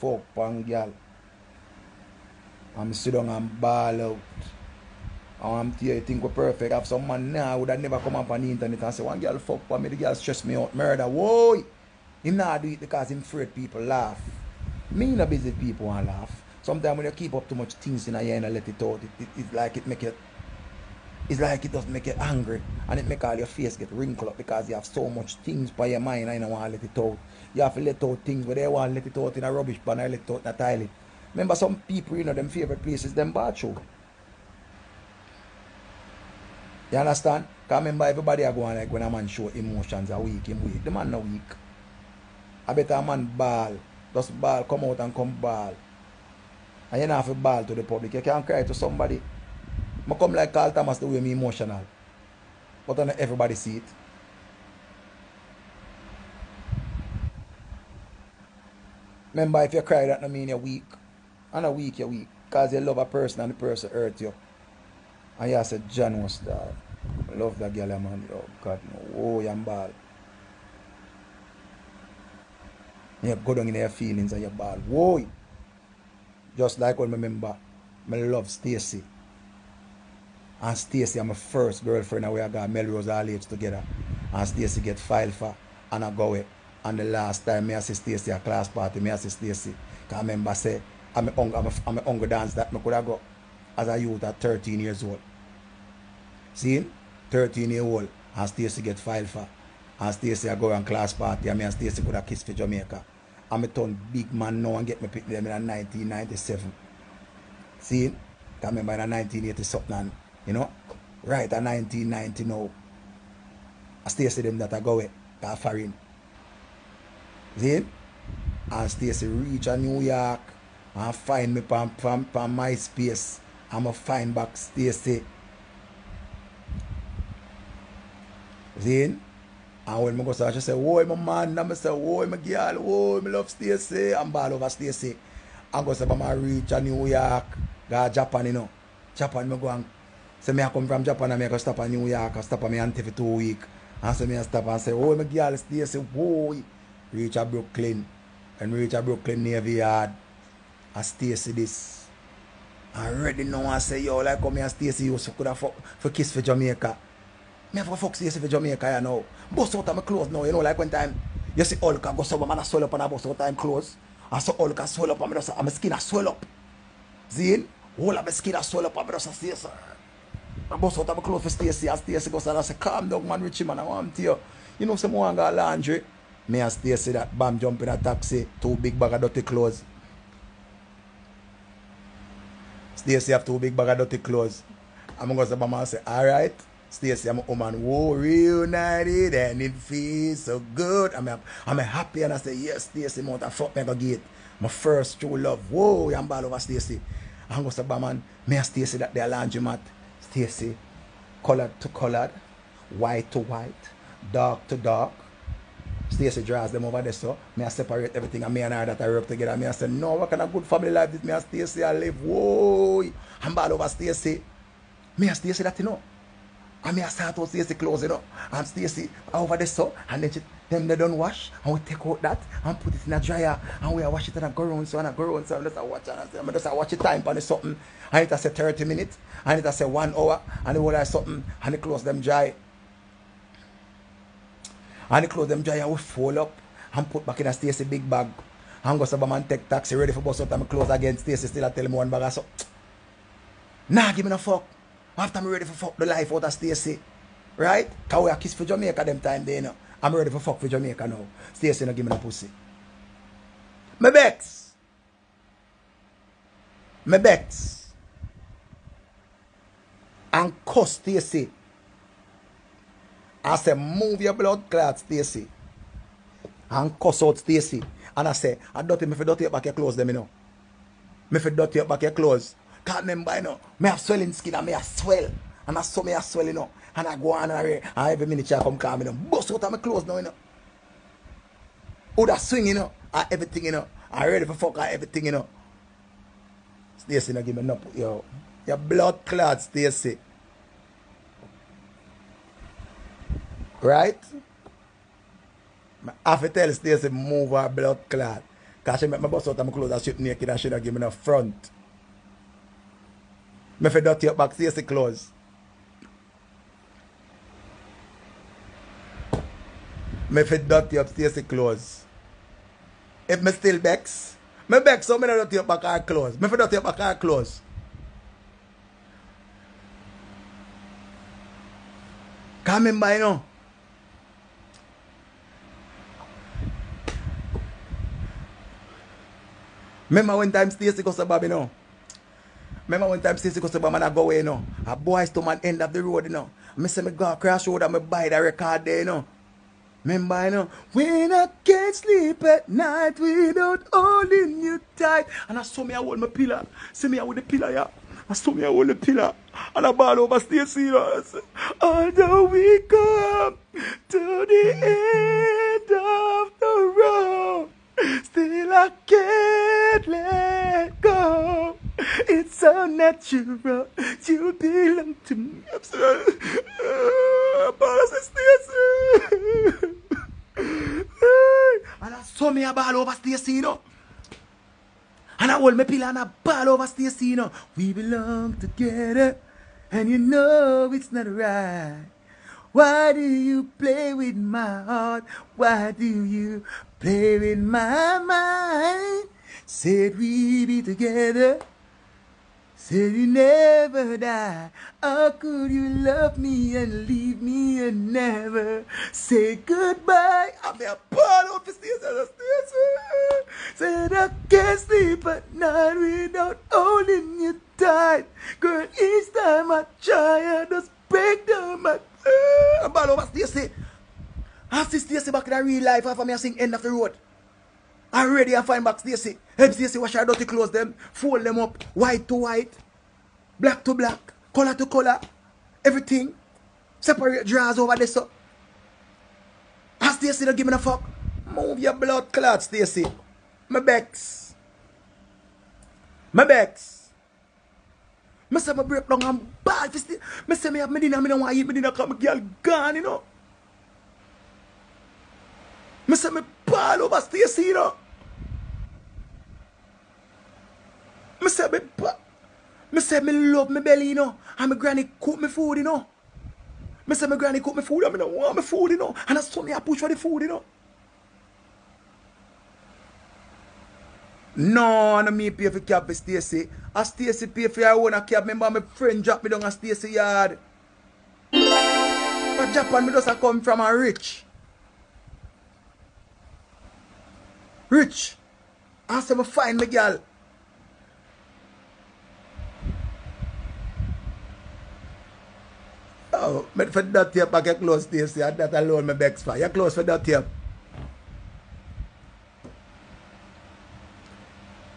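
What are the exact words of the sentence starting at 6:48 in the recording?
Girl, each time I try, I just break down my.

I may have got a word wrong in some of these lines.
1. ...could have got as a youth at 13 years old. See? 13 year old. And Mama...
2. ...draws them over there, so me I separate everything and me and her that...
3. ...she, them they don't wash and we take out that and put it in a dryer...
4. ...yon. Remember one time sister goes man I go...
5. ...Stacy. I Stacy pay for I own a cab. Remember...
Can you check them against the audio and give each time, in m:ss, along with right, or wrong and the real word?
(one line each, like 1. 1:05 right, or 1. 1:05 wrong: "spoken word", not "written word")
1. 1:32 wrong: "Stacy", not "Mama"
2. 3:26 right
3. 3:40 right
4. 5:31 right
5. 7:46 right.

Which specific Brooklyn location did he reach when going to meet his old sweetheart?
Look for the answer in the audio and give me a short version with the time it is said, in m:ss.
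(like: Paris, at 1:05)
Brooklyn Navy Yard, at 2:29.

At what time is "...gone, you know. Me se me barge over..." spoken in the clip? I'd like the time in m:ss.
7:22.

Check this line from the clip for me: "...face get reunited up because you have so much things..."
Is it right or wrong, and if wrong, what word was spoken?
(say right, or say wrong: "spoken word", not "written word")
wrong: "wrinkled", not "reunited".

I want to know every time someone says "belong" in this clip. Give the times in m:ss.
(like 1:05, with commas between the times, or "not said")
6:04, 6:17.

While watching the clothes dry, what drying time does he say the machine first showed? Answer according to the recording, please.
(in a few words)
30 minutes.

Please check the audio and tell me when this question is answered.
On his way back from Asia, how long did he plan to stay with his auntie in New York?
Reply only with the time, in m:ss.
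2:23.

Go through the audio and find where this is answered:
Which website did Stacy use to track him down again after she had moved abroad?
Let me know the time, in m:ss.
2:01.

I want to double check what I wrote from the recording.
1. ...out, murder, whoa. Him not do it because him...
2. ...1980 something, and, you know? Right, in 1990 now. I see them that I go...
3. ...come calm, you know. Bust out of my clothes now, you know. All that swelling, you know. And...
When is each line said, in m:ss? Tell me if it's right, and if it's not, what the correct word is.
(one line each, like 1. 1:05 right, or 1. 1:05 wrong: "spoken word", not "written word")
1. 0:10 right
2. 1:49 right
3. 4:38 wrong: "swing", not "swelling".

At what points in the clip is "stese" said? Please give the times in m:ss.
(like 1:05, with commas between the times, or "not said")
5:04, 5:11, 5:30.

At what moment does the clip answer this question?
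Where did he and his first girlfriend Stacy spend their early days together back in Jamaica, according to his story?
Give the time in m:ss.
1:22.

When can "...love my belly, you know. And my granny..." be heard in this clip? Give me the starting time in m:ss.
7:33.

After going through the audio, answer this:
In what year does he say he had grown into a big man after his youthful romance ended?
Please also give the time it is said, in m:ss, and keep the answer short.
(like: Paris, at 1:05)
1997, at 1:45.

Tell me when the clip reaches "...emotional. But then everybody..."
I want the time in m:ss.
0:51.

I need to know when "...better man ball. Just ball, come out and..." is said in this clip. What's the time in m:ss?
0:42.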